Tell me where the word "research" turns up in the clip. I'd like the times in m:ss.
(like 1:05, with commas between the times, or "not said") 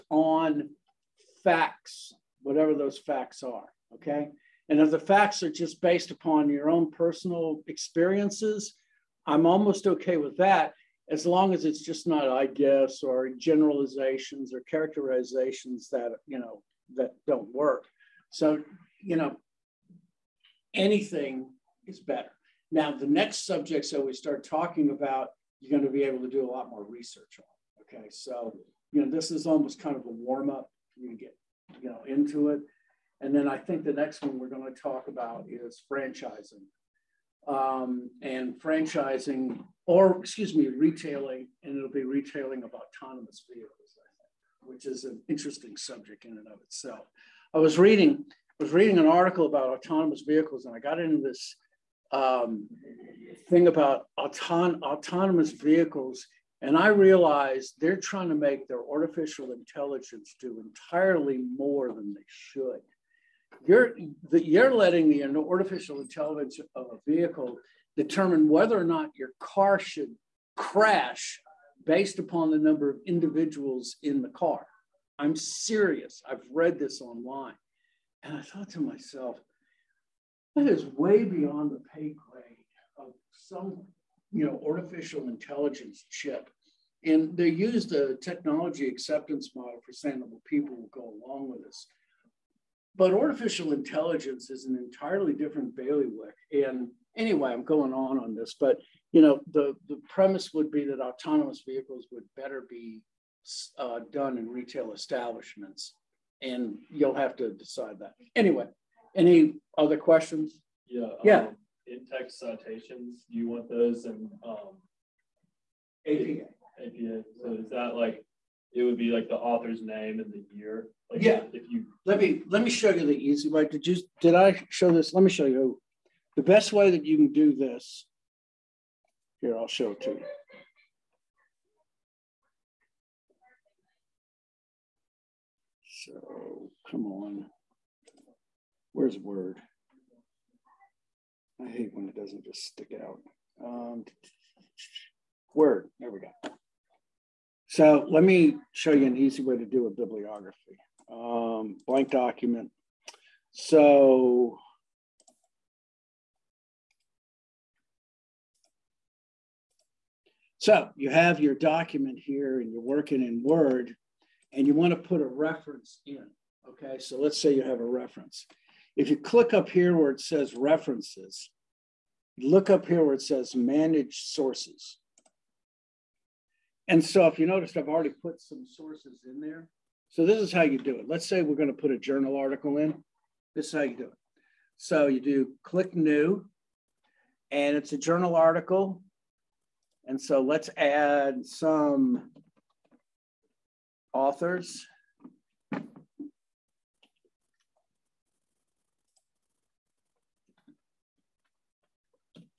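0:26.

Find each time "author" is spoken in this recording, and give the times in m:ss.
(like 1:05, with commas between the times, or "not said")
1:59, 3:14.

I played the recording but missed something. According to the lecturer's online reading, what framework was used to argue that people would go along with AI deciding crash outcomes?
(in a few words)
Technology acceptance model.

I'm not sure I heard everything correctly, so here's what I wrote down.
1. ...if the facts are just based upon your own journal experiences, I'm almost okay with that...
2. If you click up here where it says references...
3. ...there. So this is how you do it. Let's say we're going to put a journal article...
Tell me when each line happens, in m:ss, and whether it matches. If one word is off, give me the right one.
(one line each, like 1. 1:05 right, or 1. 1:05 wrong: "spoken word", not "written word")
1. 0:04 wrong: "personal", not "journal"
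2. 2:48 right
3. 2:59 right.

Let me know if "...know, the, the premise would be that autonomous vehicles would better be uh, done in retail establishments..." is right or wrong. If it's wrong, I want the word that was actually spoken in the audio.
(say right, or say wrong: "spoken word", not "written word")
right.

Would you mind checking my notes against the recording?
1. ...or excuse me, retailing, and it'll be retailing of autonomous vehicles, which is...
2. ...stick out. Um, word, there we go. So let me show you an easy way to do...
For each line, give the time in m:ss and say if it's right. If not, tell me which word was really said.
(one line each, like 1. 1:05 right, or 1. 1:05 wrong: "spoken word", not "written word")
1. 0:39 right
2. 2:22 right.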